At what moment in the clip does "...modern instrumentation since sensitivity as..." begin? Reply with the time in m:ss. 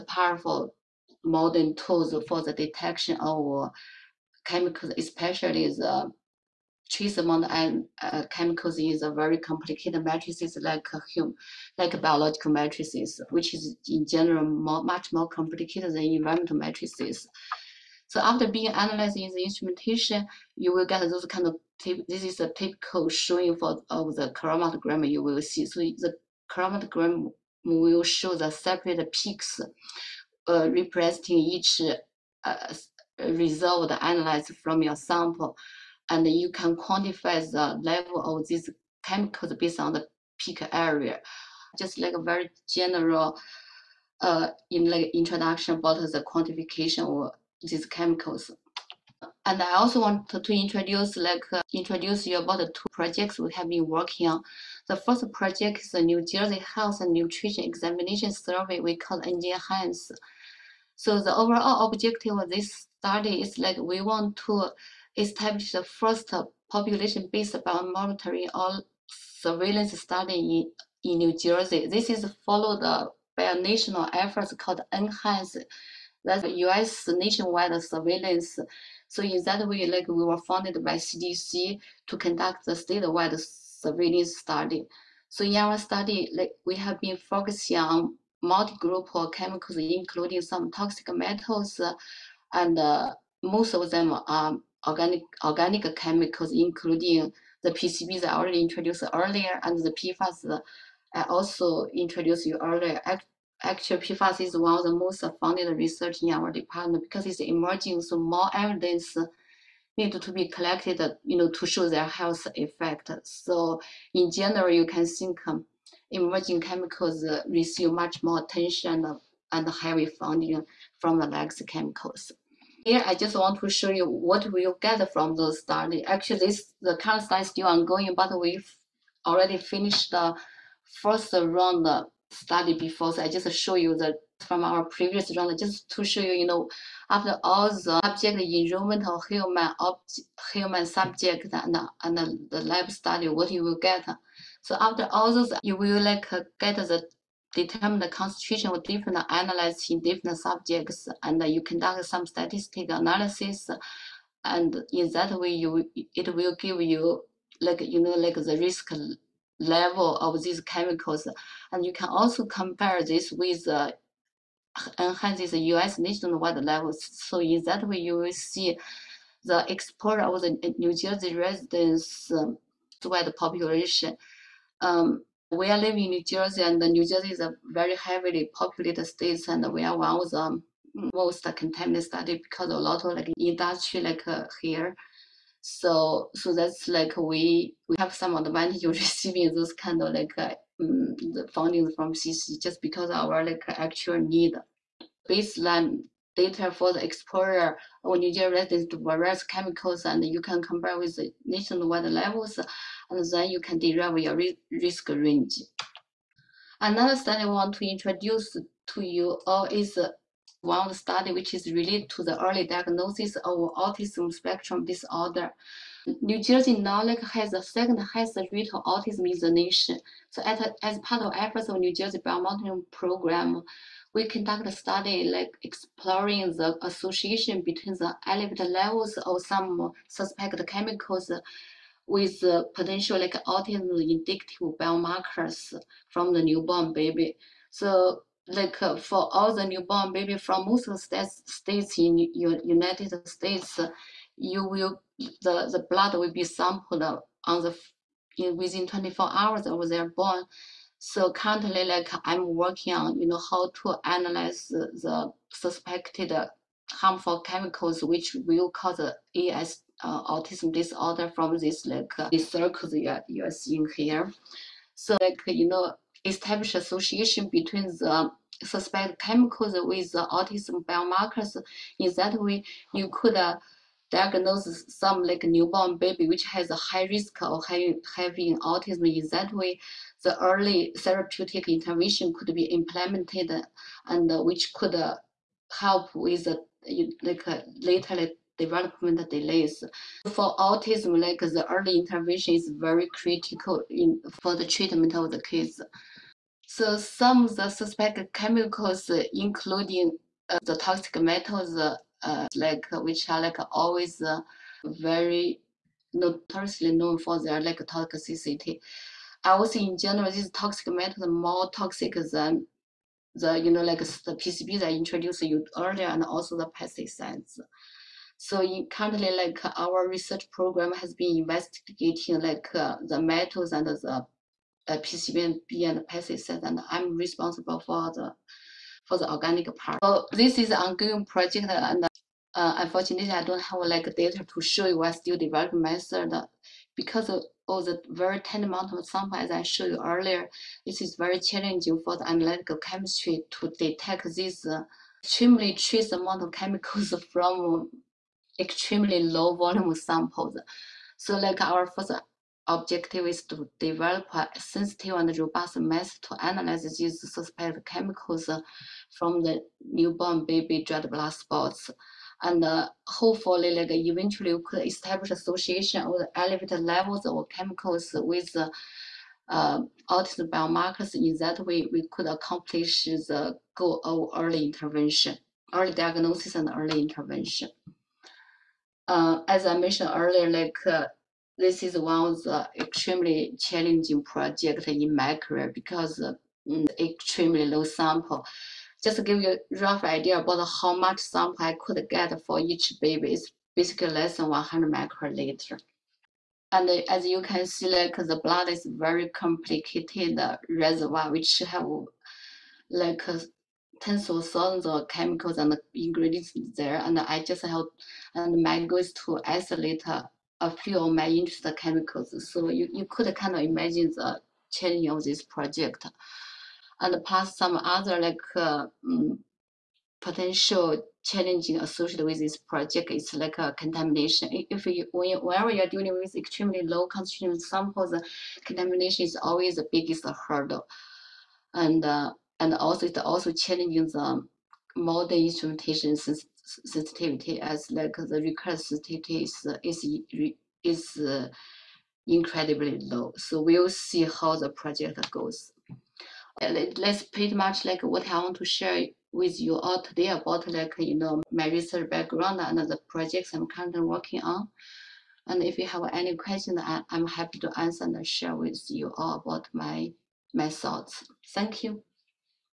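7:14.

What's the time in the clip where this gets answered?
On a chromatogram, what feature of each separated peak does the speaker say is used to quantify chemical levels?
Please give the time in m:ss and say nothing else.
0:40.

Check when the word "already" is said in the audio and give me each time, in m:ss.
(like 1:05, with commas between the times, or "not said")
1:38, 2:09.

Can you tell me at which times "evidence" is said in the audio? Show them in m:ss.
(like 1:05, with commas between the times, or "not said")
1:48.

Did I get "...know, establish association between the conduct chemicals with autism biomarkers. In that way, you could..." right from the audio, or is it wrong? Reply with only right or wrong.
wrong.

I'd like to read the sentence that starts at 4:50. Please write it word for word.
For autism, like the early intervention is very critical in, for the treatment of the kids.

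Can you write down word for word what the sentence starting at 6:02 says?
And uh, hopefully, like eventually, we could establish association of elevated levels of chemicals with uh, uh, autism biomarkers.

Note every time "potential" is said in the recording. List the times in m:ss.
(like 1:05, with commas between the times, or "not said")
3:52, 7:00.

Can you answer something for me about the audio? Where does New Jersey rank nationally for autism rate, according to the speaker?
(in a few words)
second highest.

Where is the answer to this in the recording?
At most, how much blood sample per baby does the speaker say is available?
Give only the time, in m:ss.
6:34.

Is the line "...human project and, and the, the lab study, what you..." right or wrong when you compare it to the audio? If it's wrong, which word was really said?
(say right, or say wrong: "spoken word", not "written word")
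wrong: "subject", not "project".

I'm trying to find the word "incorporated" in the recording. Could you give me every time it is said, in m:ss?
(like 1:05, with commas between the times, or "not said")
not said.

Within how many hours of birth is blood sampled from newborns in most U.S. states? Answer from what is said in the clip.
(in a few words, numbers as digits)
24 hours.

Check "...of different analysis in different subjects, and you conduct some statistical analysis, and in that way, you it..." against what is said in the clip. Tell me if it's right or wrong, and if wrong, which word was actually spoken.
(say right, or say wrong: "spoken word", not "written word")
right.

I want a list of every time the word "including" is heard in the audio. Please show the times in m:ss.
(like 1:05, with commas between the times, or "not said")
1:29, 1:36, 4:59.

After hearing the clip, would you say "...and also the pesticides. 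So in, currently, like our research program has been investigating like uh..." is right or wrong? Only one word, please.
right.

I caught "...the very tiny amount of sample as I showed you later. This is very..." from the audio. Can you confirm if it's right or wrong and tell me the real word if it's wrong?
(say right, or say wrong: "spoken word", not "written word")
wrong: "earlier", not "later".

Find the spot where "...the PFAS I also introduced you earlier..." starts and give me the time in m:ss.
1:39.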